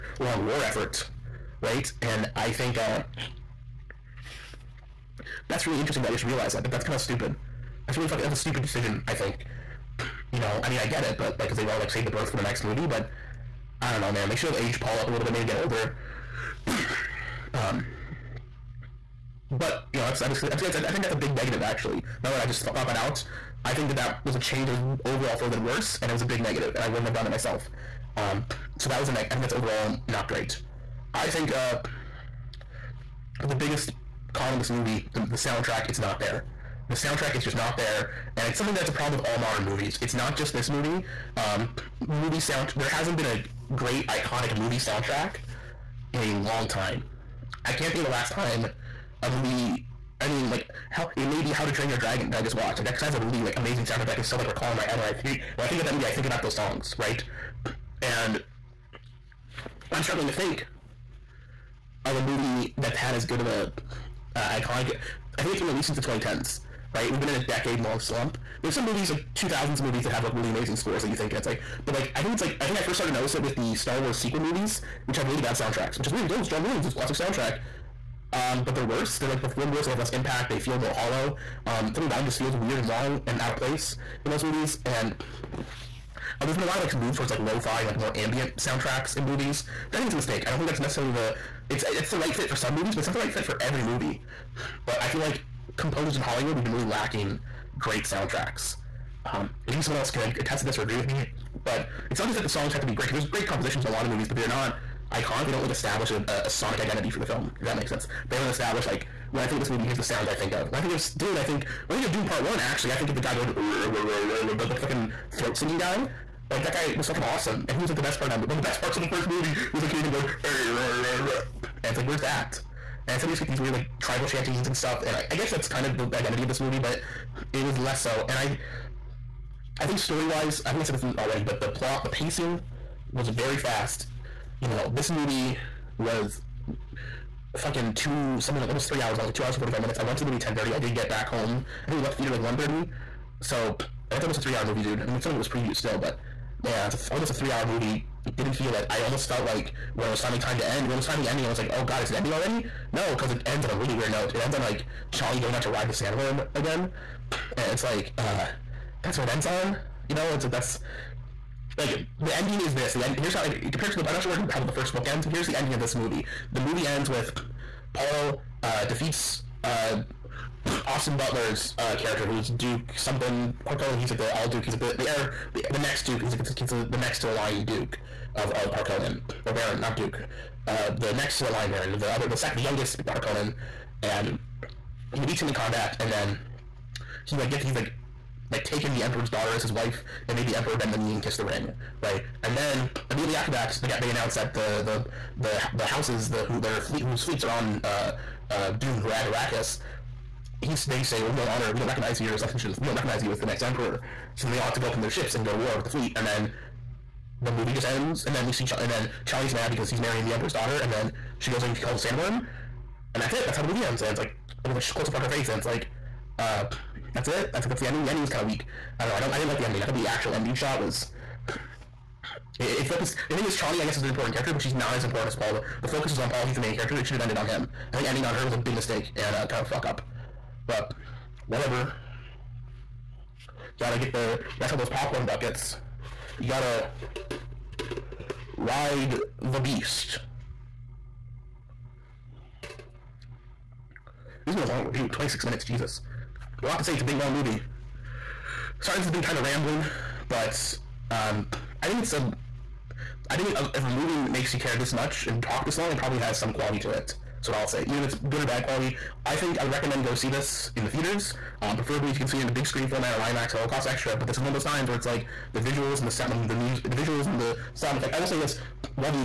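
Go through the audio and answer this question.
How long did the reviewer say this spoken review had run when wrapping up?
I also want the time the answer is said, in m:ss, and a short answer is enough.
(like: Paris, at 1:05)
26 minutes, at 4:05.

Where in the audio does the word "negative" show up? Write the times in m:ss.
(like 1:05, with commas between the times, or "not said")
0:21, 0:26.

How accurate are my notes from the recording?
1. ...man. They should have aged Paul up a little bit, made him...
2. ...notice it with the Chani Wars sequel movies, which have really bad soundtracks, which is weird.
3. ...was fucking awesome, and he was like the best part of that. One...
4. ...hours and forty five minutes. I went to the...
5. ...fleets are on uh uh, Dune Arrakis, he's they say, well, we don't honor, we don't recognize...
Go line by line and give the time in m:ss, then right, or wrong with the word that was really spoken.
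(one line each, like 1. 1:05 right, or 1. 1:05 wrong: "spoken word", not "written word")
1. 0:14 right
2. 1:13 wrong: "Star", not "Chani"
3. 1:56 right
4. 2:19 right
5. 3:17 right.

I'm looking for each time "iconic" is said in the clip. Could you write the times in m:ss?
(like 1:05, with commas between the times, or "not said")
0:44, 1:04, 1:45.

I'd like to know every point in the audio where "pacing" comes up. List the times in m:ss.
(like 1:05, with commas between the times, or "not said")
2:12.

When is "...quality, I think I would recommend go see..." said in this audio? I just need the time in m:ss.
4:18.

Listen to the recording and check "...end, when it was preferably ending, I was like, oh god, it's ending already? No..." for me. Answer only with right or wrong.
wrong.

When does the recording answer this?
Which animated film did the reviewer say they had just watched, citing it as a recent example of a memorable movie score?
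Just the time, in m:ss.
0:51.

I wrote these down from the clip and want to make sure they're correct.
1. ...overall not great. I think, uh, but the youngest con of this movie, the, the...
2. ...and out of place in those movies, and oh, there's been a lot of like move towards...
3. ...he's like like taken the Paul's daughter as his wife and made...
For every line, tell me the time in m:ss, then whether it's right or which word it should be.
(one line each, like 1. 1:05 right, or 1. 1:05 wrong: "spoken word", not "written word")
1. 0:29 wrong: "biggest", not "youngest"
2. 1:23 right
3. 3:07 wrong: "Emperor", not "Paul".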